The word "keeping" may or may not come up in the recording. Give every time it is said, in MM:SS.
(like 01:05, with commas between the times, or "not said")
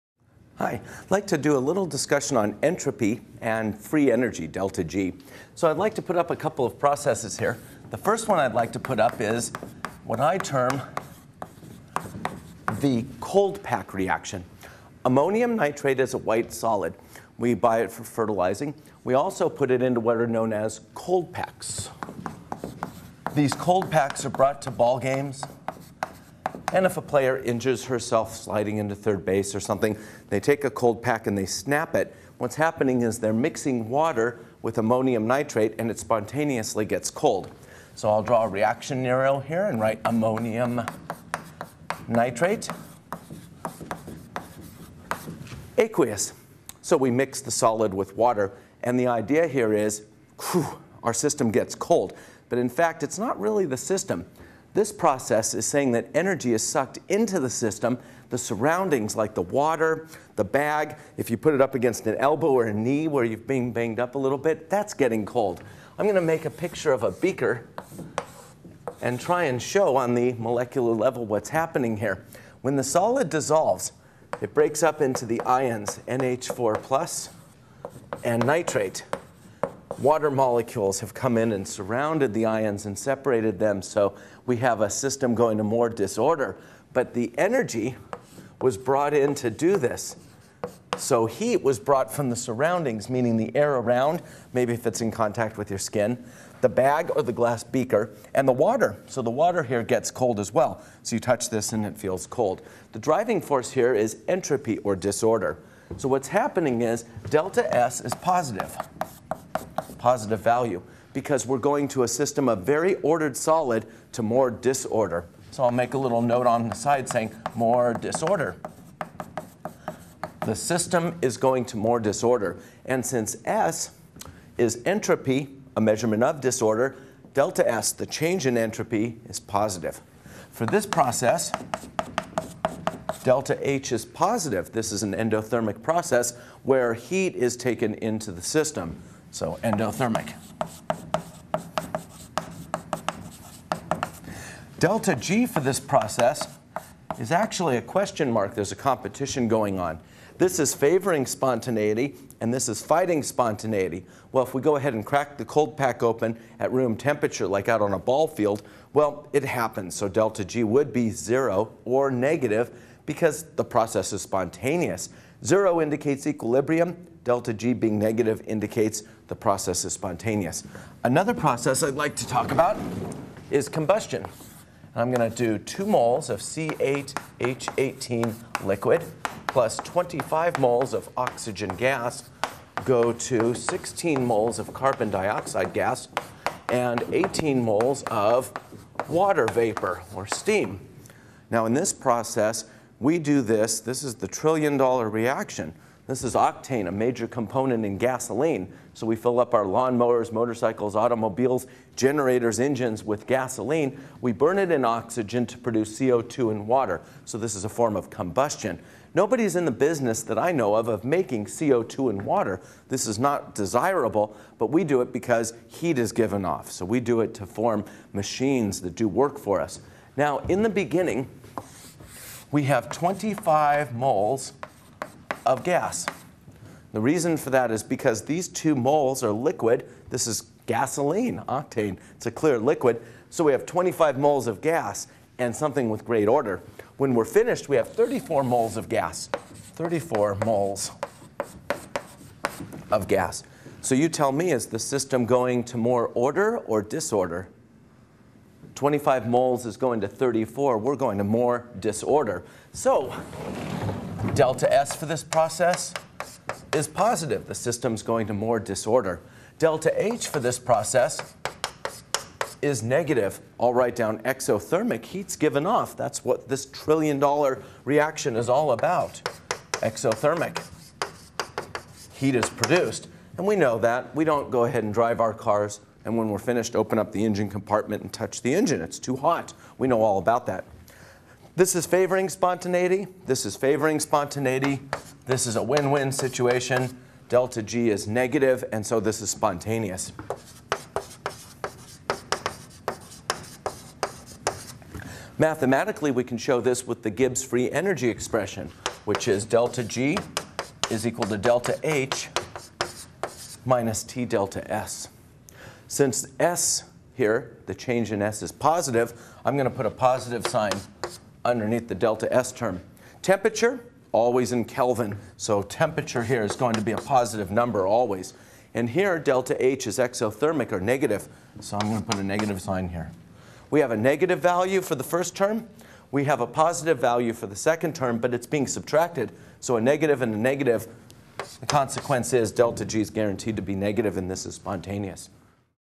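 not said.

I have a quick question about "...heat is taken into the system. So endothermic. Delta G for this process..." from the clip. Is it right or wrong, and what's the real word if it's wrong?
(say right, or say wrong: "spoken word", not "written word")
right.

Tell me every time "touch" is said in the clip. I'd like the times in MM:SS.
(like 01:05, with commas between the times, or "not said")
01:41, 04:38.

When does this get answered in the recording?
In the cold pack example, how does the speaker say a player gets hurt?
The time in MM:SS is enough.
00:28.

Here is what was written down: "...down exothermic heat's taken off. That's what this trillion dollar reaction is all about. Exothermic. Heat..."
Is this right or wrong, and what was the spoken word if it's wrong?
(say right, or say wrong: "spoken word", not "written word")
wrong: "given", not "taken".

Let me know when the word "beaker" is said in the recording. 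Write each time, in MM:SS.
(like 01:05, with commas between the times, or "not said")
01:07, 01:37.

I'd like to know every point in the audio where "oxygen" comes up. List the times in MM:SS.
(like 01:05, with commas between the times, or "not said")
03:01, 03:24.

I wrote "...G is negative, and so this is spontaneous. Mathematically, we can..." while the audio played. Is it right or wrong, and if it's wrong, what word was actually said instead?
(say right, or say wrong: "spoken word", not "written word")
right.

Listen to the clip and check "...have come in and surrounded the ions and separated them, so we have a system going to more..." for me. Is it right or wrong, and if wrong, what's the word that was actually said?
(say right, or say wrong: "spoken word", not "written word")
right.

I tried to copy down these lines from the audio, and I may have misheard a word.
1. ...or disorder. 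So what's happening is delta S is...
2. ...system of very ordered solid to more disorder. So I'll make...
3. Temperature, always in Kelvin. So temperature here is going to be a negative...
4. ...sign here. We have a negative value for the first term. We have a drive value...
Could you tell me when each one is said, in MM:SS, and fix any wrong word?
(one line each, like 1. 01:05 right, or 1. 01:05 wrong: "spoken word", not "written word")
1. 01:44 right
2. 01:52 right
3. 05:13 wrong: "positive", not "negative"
4. 05:22 wrong: "positive", not "drive".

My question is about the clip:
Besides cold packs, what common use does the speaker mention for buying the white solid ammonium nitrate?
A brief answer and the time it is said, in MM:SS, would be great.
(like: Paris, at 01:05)
fertilizing, at 00:18.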